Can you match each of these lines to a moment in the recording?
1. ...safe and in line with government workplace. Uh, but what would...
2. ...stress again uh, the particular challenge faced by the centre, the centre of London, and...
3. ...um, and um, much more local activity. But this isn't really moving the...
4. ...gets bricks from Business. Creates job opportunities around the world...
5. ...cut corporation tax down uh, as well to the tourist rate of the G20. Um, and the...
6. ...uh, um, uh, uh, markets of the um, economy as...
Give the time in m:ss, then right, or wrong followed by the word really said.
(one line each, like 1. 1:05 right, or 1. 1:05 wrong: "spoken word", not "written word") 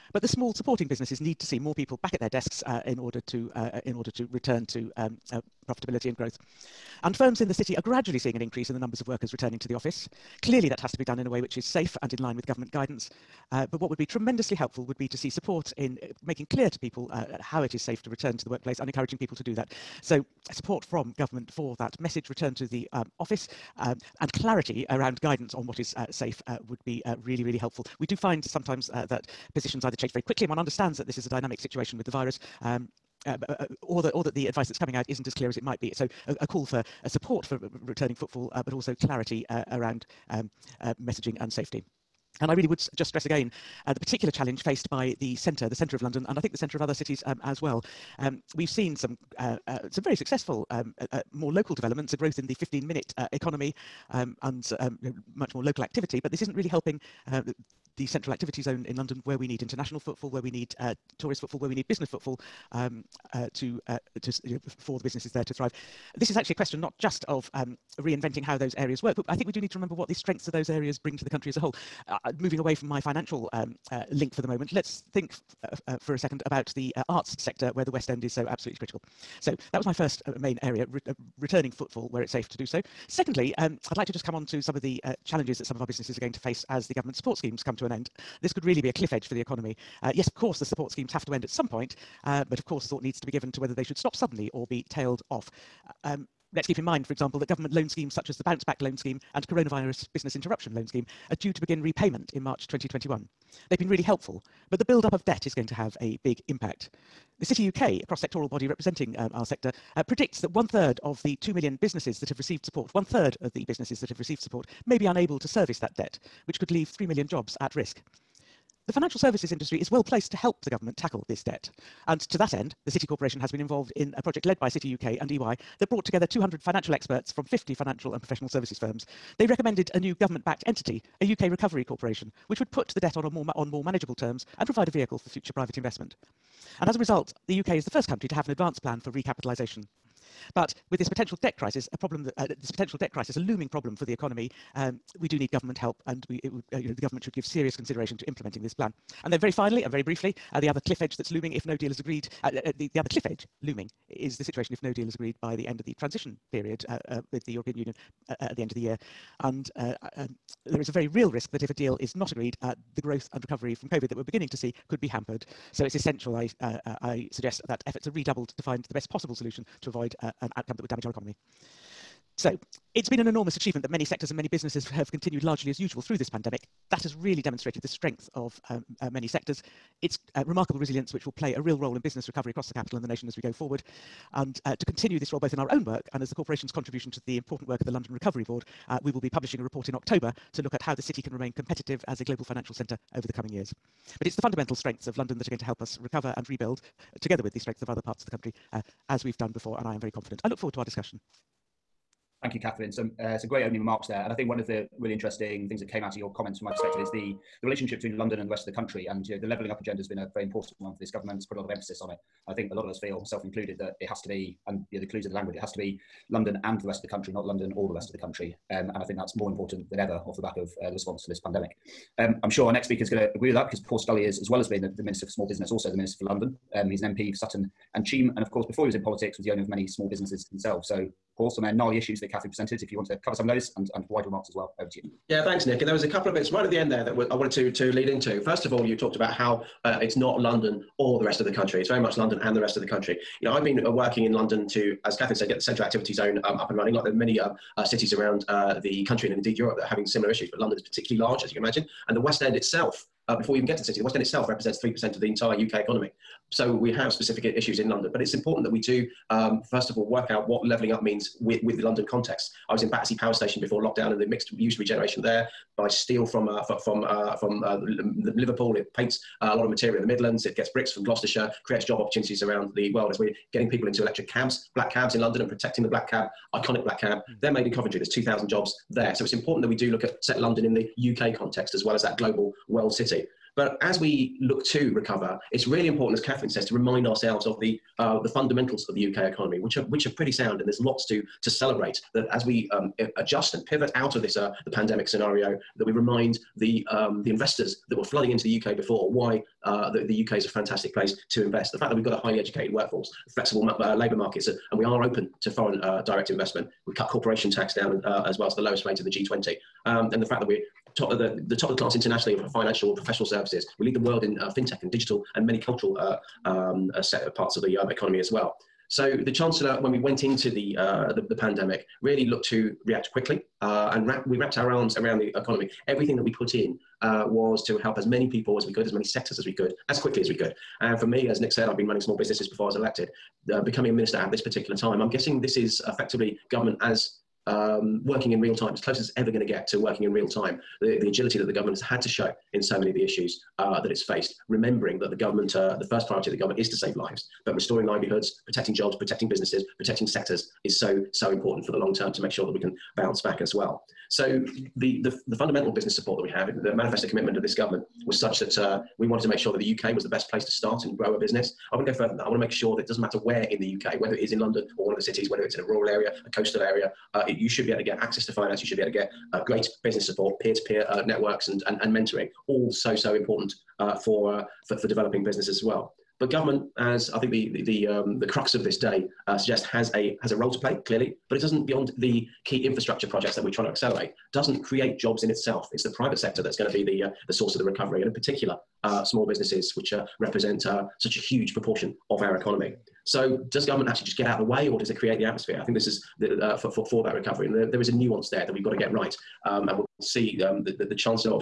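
1. 0:11 wrong: "guidance", not "workplace"
2. 0:43 right
3. 0:54 wrong: "helping", not "moving"
4. 4:30 wrong: "Gloucestershire", not "Business"
5. 5:06 wrong: "lowest", not "tourist"
6. 5:15 wrong: "parts", not "markets".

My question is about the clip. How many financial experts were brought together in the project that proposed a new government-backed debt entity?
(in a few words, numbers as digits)
200.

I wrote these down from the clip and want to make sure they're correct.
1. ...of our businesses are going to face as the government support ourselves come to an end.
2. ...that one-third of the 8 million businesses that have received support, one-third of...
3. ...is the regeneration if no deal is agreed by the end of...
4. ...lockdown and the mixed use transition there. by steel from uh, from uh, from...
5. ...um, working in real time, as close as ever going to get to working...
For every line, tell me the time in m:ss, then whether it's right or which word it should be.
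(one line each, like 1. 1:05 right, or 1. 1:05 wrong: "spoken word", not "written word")
1. 1:25 wrong: "schemes", not "ourselves"
2. 1:50 wrong: "2", not "8"
3. 2:34 wrong: "situation", not "regeneration"
4. 4:23 wrong: "regeneration", not "transition"
5. 5:37 right.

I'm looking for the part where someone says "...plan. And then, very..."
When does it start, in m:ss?
2:28.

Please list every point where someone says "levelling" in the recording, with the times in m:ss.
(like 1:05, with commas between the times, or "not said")
3:29, 4:20.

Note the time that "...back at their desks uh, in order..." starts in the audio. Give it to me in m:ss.
0:02.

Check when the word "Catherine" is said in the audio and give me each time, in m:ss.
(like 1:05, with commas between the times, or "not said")
3:22, 3:52, 4:05, 4:46.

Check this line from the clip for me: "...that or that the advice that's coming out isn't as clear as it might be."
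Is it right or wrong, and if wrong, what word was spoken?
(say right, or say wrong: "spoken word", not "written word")
right.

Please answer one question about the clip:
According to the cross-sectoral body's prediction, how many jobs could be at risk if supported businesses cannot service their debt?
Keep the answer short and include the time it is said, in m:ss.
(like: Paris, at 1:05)
3 million, at 1:56.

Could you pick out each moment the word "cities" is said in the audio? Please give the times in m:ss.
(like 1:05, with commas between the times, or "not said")
0:46, 4:07, 6:05.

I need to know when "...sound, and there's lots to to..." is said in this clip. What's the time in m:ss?
4:50.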